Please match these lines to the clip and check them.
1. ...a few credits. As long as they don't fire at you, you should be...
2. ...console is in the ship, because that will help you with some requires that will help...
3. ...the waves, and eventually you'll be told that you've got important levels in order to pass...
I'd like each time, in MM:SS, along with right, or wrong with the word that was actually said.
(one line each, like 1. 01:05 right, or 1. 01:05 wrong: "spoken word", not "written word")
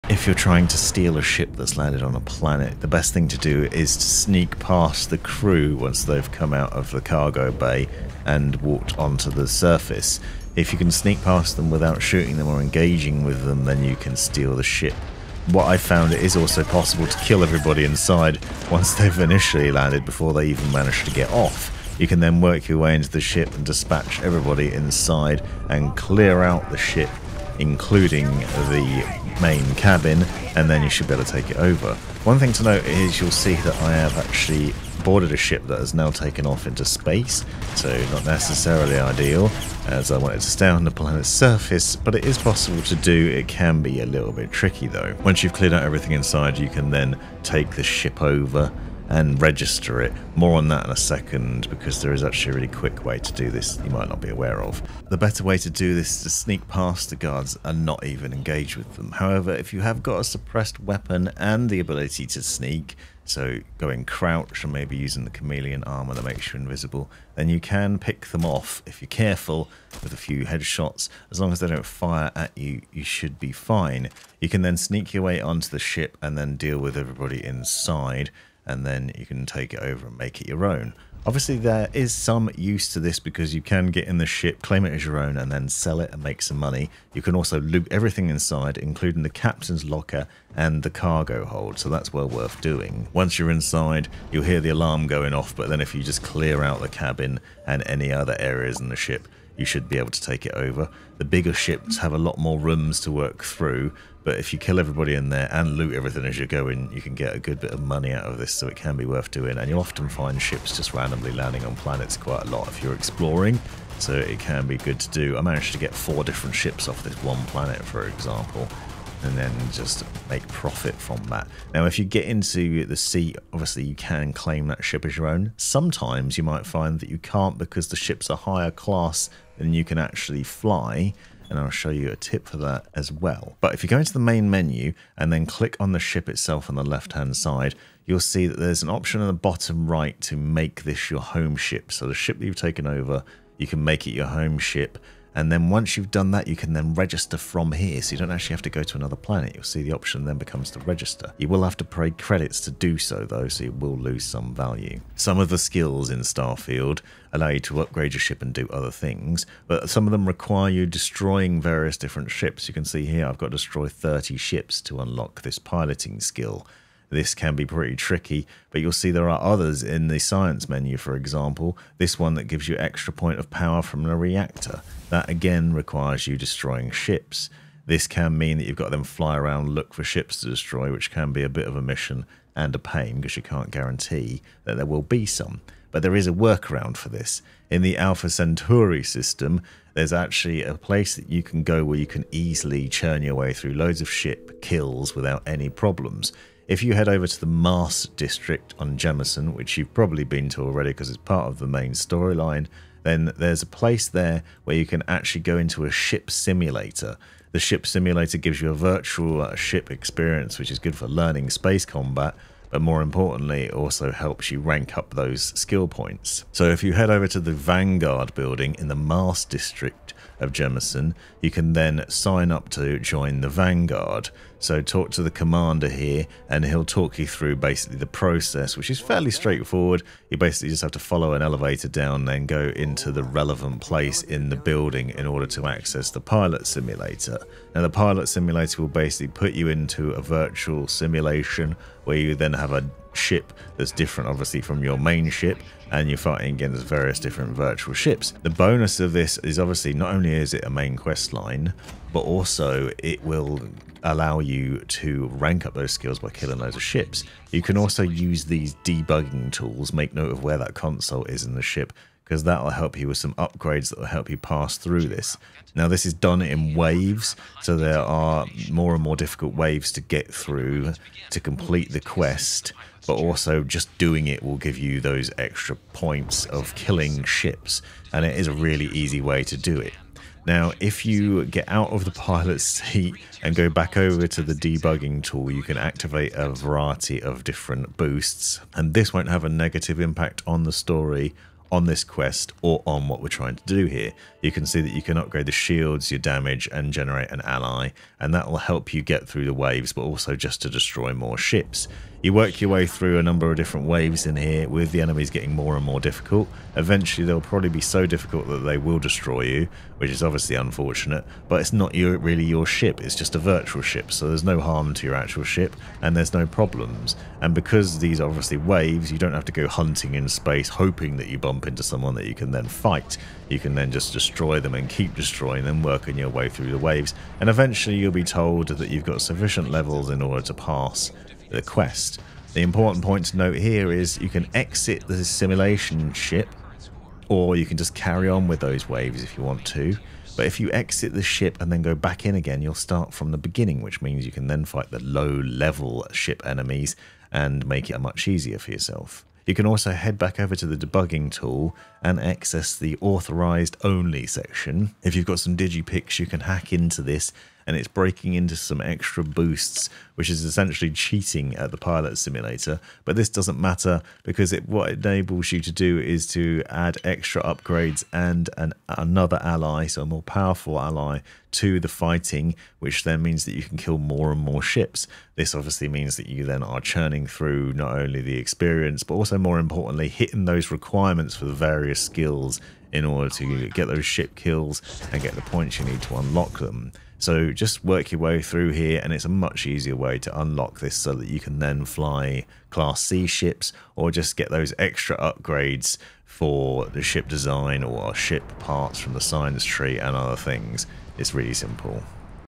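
1. 01:10 wrong: "headshots", not "credits"
2. 04:20 wrong: "upgrades", not "requires"
3. 05:26 wrong: "sufficient", not "important".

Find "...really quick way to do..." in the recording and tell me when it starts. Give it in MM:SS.
00:52.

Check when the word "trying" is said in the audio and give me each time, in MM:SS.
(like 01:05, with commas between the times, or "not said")
00:00, 04:53.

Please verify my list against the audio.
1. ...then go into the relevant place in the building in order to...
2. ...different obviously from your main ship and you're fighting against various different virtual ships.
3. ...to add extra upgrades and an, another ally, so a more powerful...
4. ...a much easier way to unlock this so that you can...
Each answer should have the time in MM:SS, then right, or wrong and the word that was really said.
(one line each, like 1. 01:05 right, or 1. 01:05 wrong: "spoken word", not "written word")
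1. 03:52 right
2. 04:03 right
3. 06:06 right
4. 06:29 right.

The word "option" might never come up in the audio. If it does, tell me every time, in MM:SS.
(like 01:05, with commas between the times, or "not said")
02:18, 02:29.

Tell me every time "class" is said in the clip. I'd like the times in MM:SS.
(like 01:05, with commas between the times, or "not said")
02:08, 06:32.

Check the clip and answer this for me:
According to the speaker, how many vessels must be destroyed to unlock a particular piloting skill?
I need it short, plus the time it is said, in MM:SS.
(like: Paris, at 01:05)
30, at 02:43.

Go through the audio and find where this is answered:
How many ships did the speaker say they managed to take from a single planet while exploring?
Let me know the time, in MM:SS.
01:55.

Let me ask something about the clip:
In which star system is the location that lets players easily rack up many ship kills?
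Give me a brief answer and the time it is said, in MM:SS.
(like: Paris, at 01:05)
Alpha Centauri, at 03:07.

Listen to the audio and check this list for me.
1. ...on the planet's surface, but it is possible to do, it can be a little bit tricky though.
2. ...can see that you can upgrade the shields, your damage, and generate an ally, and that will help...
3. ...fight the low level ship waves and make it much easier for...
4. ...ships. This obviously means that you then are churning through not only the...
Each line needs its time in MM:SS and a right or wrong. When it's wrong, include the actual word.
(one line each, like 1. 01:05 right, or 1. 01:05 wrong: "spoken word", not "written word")
1. 00:40 right
2. 04:54 right
3. 05:44 wrong: "enemies", not "waves"
4. 06:14 right.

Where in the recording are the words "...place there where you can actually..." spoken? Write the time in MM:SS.
03:23.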